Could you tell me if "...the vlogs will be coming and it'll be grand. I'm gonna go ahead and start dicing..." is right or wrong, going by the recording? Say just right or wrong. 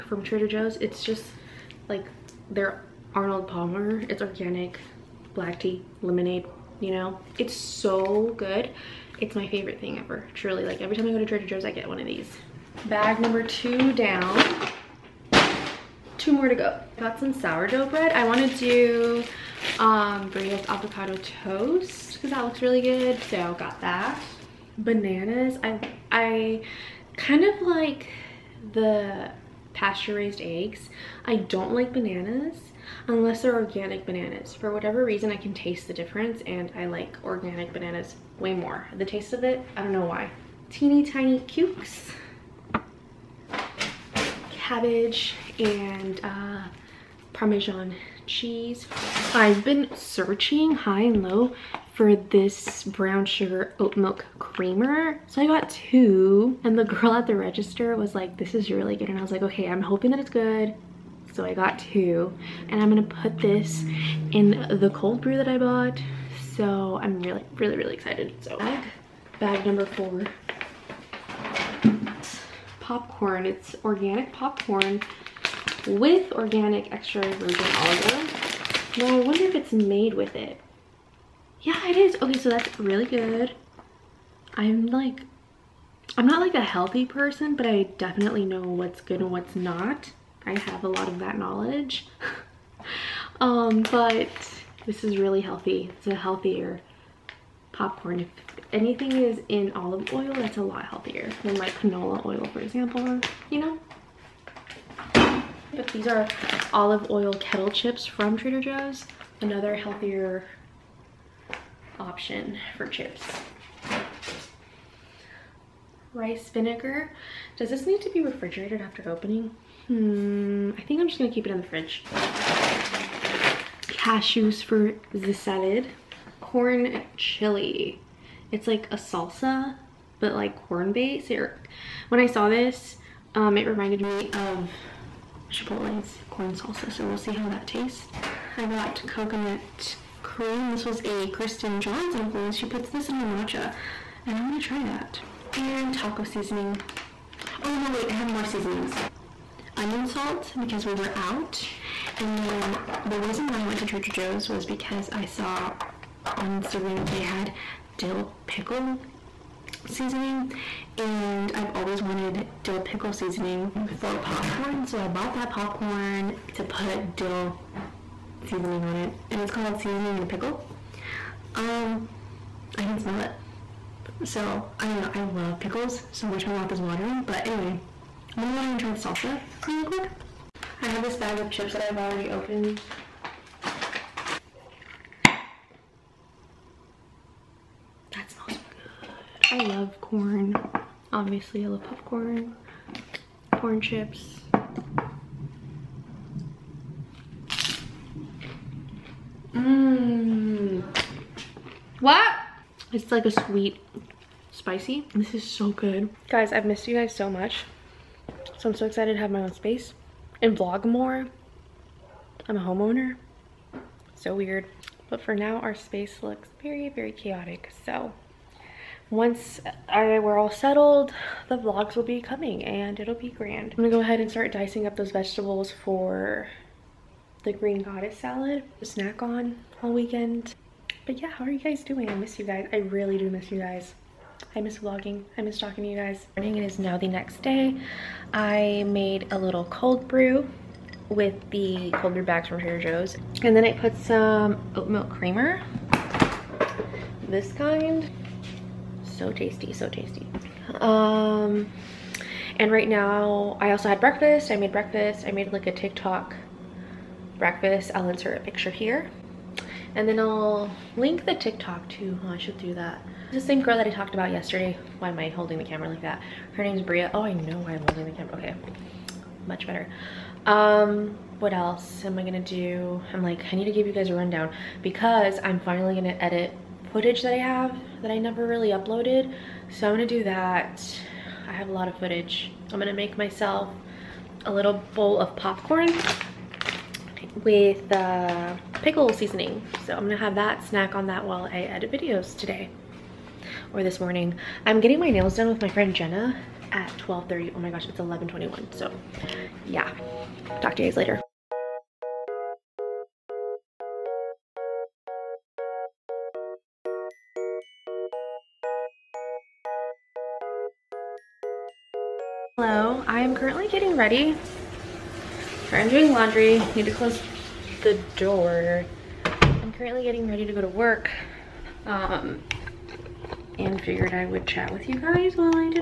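right.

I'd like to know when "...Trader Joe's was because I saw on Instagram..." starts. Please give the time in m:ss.
2:33.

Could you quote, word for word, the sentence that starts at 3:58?
I made a little cold brew with the cold brew bags from Trader Joe's.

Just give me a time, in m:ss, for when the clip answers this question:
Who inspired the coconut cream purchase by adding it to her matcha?
2:21.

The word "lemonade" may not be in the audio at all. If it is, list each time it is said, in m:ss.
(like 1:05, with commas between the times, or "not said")
0:06.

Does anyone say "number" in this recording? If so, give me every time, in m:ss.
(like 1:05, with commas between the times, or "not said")
0:13, 1:09.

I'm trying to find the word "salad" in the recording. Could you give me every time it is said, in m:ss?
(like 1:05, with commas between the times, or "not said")
2:05, 3:48.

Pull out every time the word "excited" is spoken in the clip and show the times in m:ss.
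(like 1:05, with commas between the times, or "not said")
1:07, 3:28.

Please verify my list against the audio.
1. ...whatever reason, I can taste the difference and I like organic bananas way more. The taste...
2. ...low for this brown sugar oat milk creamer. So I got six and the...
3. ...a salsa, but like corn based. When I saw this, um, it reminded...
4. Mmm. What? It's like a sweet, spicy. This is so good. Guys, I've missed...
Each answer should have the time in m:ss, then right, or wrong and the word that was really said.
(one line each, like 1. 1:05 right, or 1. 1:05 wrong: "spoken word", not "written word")
1. 0:34 right
2. 0:51 wrong: "two", not "six"
3. 2:08 right
4. 3:19 right.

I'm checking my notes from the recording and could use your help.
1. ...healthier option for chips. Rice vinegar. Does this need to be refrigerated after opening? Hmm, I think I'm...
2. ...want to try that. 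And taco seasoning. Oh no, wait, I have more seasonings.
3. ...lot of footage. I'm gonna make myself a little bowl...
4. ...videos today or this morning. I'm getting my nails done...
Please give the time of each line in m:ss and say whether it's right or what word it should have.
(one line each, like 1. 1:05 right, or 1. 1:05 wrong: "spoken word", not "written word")
1. 1:49 right
2. 2:24 right
3. 4:41 right
4. 4:51 right.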